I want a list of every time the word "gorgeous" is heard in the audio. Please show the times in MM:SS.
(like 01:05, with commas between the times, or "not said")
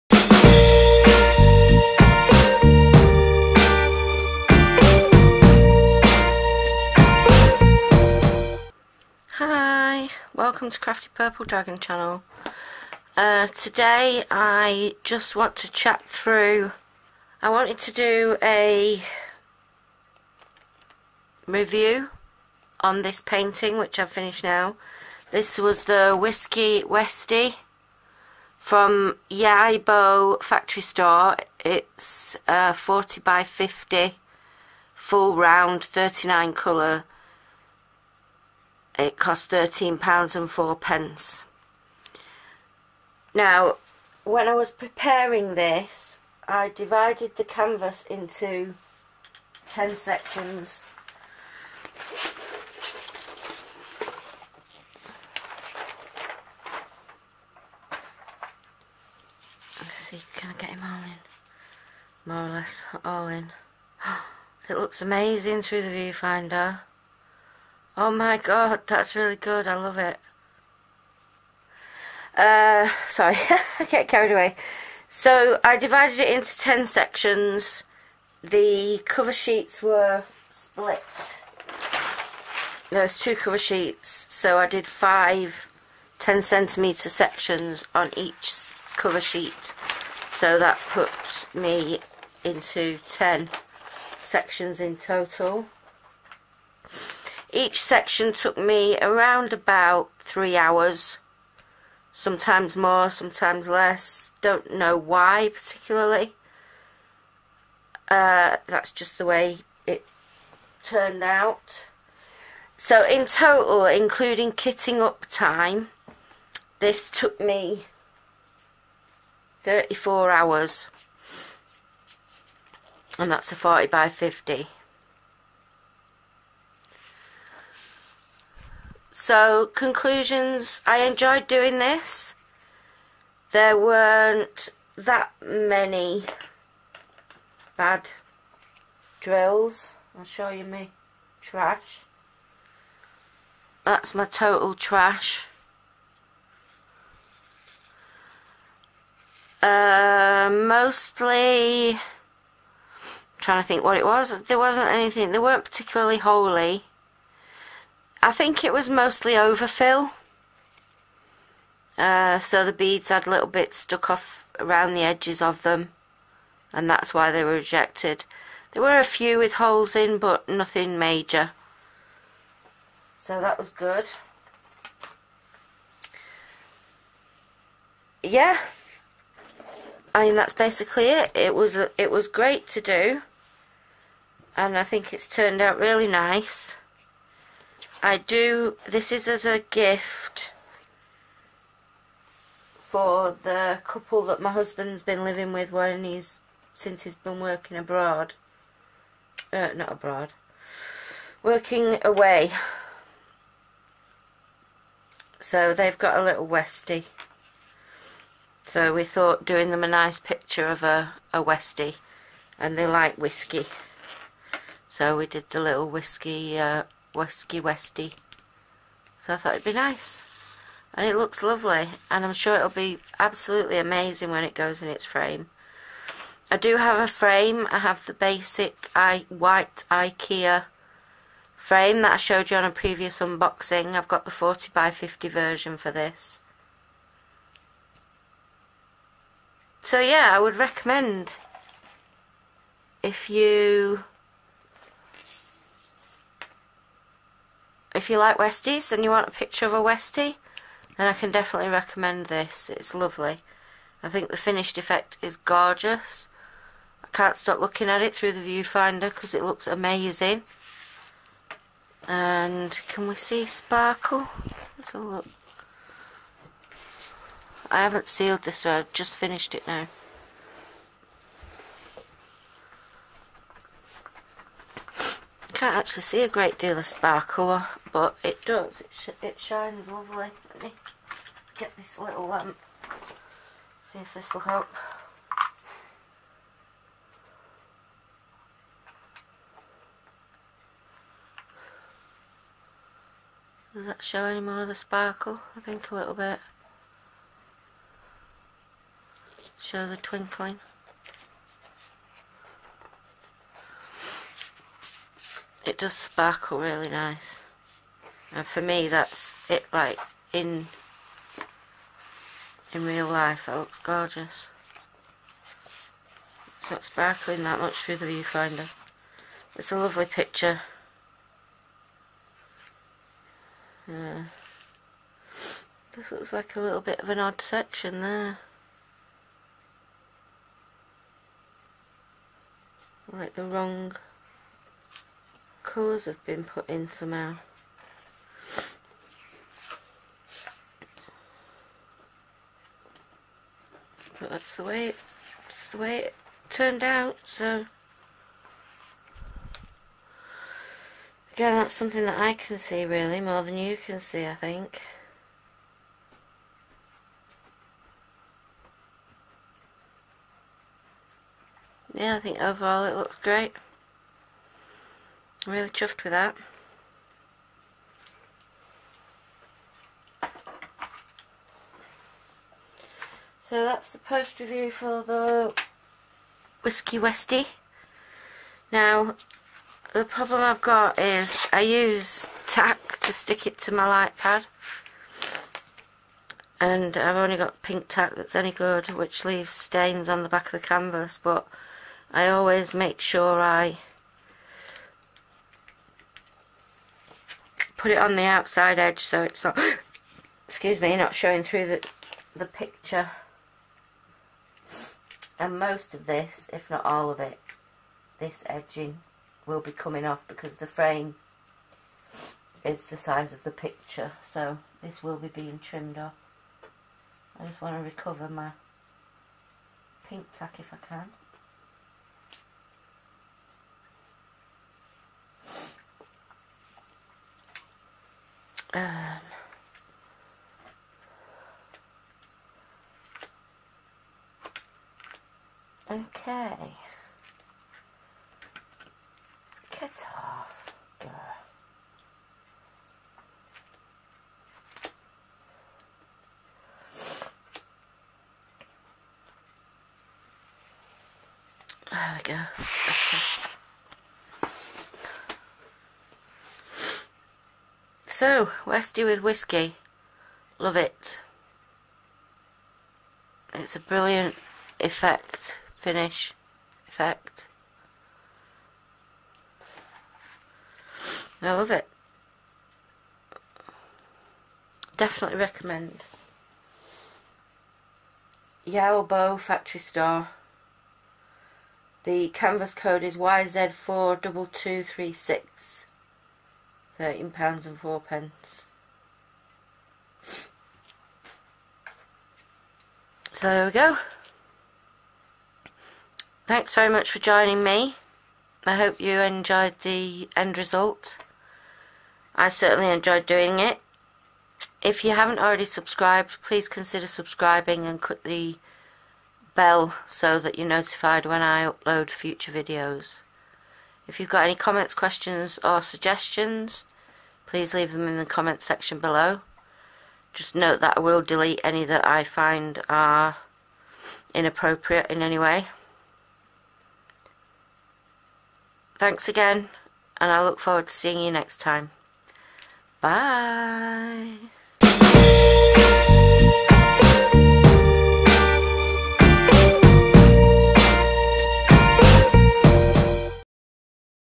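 04:15, 05:13.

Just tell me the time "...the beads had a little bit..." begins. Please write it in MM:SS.
02:42.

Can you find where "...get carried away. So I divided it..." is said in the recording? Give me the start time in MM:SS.
01:13.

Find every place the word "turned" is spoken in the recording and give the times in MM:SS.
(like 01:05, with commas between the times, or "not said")
01:50, 03:05, 05:46.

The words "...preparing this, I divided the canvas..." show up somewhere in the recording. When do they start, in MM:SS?
00:44.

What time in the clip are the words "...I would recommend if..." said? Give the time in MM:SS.
04:00.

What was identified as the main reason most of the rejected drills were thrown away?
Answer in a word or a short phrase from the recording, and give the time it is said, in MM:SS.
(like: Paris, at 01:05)
Overfill, at 02:39.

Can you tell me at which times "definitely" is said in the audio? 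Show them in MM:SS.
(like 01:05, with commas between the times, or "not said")
04:11, 07:54.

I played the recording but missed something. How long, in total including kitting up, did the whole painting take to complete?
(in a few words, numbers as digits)
34 hours.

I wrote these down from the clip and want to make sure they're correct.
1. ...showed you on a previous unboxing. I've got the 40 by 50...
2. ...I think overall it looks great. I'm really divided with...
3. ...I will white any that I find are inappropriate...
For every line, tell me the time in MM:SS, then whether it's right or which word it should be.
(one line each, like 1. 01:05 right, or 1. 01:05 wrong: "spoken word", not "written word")
1. 03:52 right
2. 06:02 wrong: "chuffed", not "divided"
3. 08:40 wrong: "delete", not "white".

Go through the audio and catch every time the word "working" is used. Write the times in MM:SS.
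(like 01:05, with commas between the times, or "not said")
03:17, 03:21.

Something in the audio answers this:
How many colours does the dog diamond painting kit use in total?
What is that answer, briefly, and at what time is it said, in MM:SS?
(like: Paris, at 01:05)
39, at 00:35.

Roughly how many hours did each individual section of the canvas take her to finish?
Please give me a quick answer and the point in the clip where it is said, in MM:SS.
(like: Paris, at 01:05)
3 hours, at 01:40.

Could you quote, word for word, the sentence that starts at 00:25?
This was the Whiskey Westie from Yaobo Factory Store.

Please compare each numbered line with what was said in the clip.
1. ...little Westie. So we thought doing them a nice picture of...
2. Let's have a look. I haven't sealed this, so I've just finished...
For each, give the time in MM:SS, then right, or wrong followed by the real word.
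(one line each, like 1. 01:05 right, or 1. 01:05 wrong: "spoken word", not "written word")
1. 03:26 right
2. 04:24 right.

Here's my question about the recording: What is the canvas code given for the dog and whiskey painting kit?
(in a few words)
YZ42236.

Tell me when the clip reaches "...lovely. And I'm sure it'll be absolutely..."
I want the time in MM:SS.
03:41.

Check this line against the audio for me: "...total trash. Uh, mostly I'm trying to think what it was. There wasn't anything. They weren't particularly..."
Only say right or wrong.
right.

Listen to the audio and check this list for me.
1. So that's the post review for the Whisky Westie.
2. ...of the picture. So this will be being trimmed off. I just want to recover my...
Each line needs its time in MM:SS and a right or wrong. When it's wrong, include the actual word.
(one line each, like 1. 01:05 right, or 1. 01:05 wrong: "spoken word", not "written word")
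1. 06:13 right
2. 06:53 right.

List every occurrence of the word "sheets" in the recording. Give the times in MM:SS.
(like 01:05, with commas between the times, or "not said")
01:19, 01:23, 01:29.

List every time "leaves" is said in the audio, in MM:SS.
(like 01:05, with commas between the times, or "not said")
06:29, 08:37.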